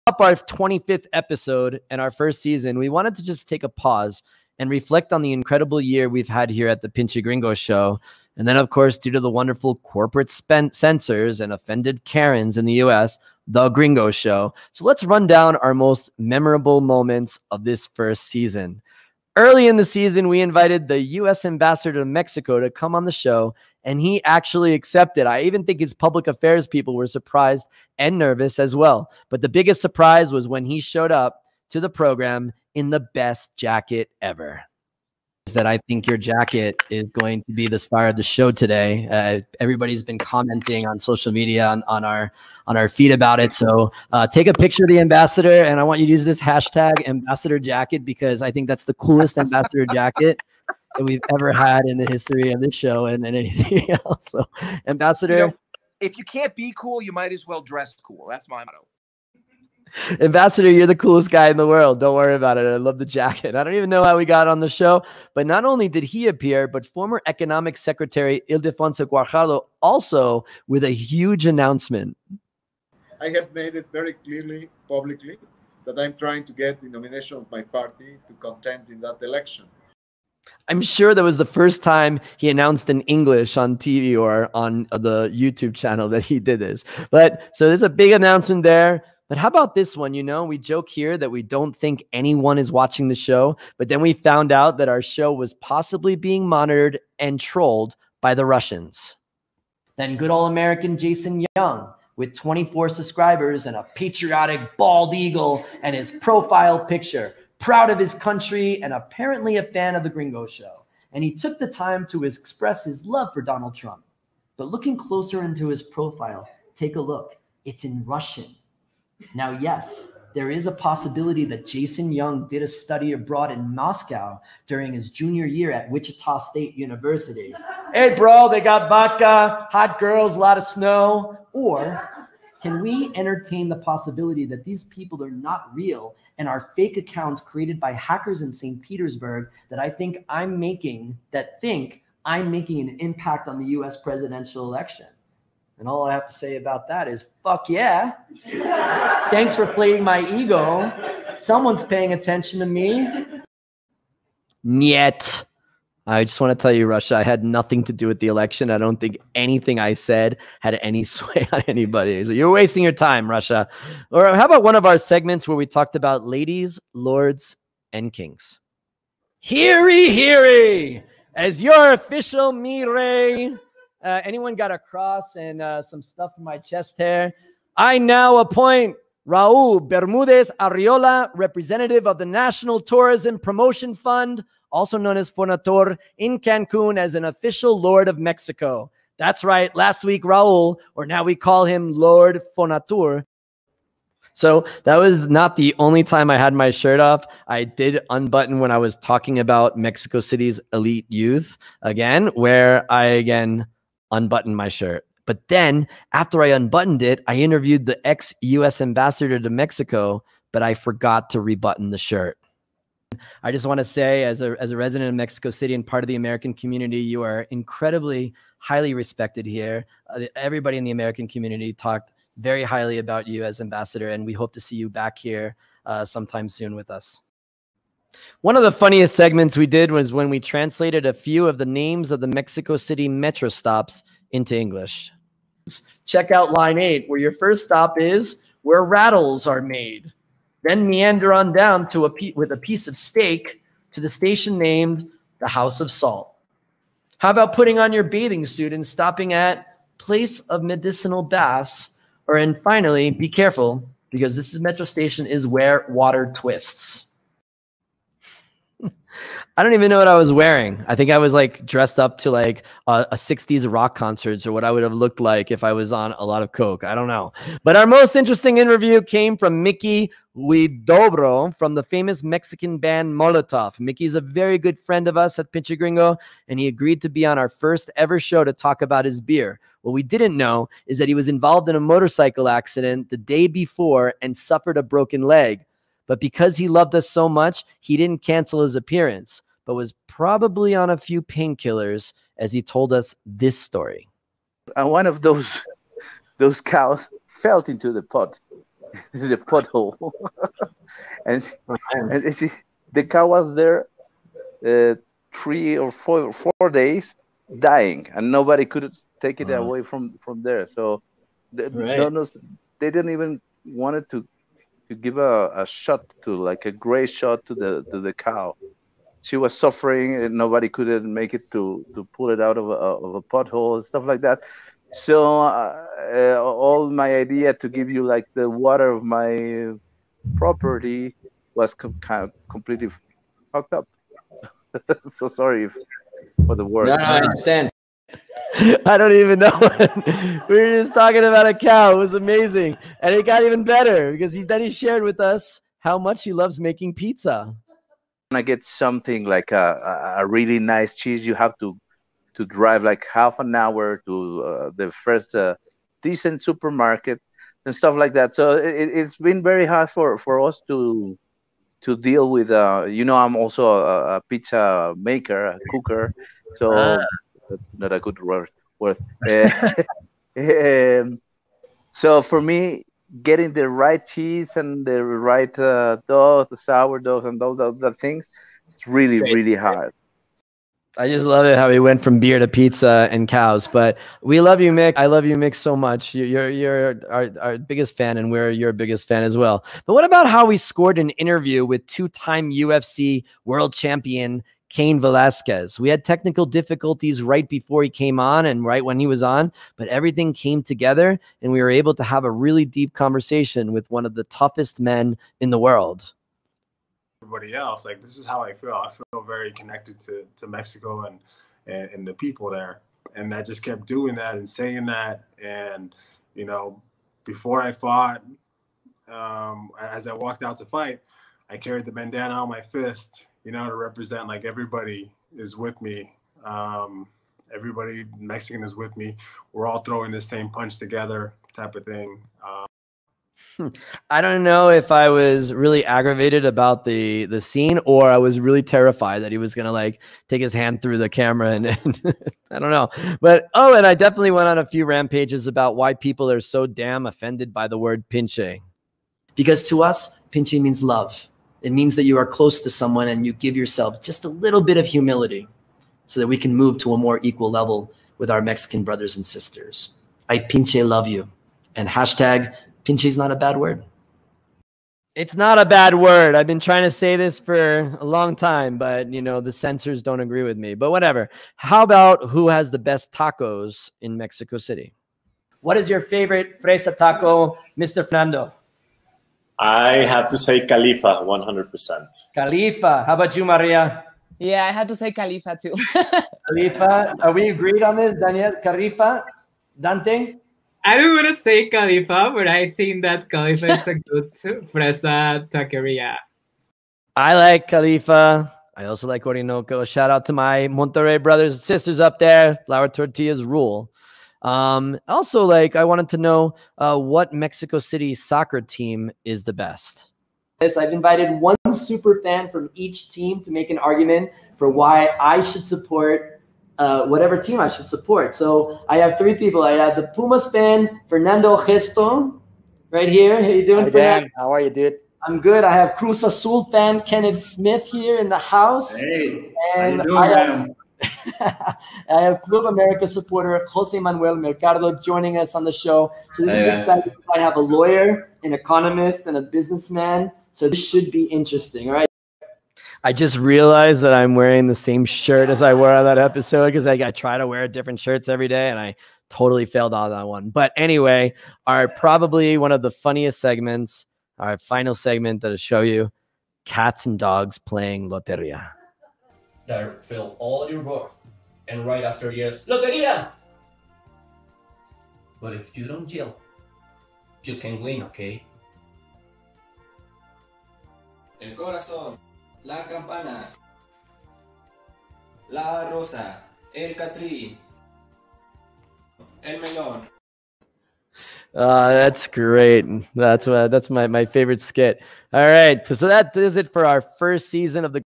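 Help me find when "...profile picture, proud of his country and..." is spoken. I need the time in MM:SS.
01:46.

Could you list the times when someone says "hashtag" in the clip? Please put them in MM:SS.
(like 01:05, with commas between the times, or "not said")
00:46, 07:41.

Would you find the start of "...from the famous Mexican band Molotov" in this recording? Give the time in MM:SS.
04:31.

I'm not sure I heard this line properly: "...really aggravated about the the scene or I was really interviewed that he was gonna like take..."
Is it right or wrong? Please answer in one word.
wrong.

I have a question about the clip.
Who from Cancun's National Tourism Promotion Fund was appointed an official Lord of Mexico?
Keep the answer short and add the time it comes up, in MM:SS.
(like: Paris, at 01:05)
Raul Bermudez Arriola, at 02:59.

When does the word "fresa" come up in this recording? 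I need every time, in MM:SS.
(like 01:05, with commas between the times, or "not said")
07:56, 08:14.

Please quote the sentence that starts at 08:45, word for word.
I have Cruz Azul fan Kenneth Smith here in the house.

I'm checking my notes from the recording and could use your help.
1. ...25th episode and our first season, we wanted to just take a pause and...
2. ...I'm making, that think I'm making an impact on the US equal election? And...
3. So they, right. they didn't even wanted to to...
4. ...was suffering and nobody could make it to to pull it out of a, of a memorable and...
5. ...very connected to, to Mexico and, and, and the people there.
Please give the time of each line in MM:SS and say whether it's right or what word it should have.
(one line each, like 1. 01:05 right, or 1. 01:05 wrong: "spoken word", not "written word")
1. 00:00 right
2. 02:20 wrong: "presidential", not "equal"
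3. 05:10 right
4. 05:19 wrong: "pothole", not "memorable"
5. 06:49 right.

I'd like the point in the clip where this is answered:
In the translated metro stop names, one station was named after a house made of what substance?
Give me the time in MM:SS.
04:05.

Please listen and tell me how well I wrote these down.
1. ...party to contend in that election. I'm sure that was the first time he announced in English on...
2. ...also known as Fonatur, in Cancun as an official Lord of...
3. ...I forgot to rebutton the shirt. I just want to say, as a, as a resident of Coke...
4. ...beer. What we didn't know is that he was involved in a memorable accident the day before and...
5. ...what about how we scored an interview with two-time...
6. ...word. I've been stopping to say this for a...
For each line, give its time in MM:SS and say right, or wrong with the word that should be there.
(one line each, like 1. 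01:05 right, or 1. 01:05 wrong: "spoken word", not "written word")
1. 01:17 right
2. 03:04 right
3. 03:30 wrong: "Mexico", not "Coke"
4. 04:39 wrong: "motorcycle", not "memorable"
5. 06:29 right
6. 07:45 wrong: "trying", not "stopping".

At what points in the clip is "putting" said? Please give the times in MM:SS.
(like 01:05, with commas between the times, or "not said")
04:07.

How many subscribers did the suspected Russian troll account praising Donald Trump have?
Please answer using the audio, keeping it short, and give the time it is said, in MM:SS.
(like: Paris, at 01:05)
24, at 01:42.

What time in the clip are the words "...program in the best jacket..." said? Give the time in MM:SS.
00:31.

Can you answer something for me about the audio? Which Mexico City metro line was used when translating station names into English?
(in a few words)
Line 8.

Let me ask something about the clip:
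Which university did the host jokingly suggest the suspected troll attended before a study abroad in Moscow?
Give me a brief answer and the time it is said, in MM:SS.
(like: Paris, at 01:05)
Wichita State University, at 02:05.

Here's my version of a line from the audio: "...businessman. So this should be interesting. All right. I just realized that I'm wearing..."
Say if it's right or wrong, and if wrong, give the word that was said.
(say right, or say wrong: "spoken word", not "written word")
right.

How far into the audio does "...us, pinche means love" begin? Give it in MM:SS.
07:29.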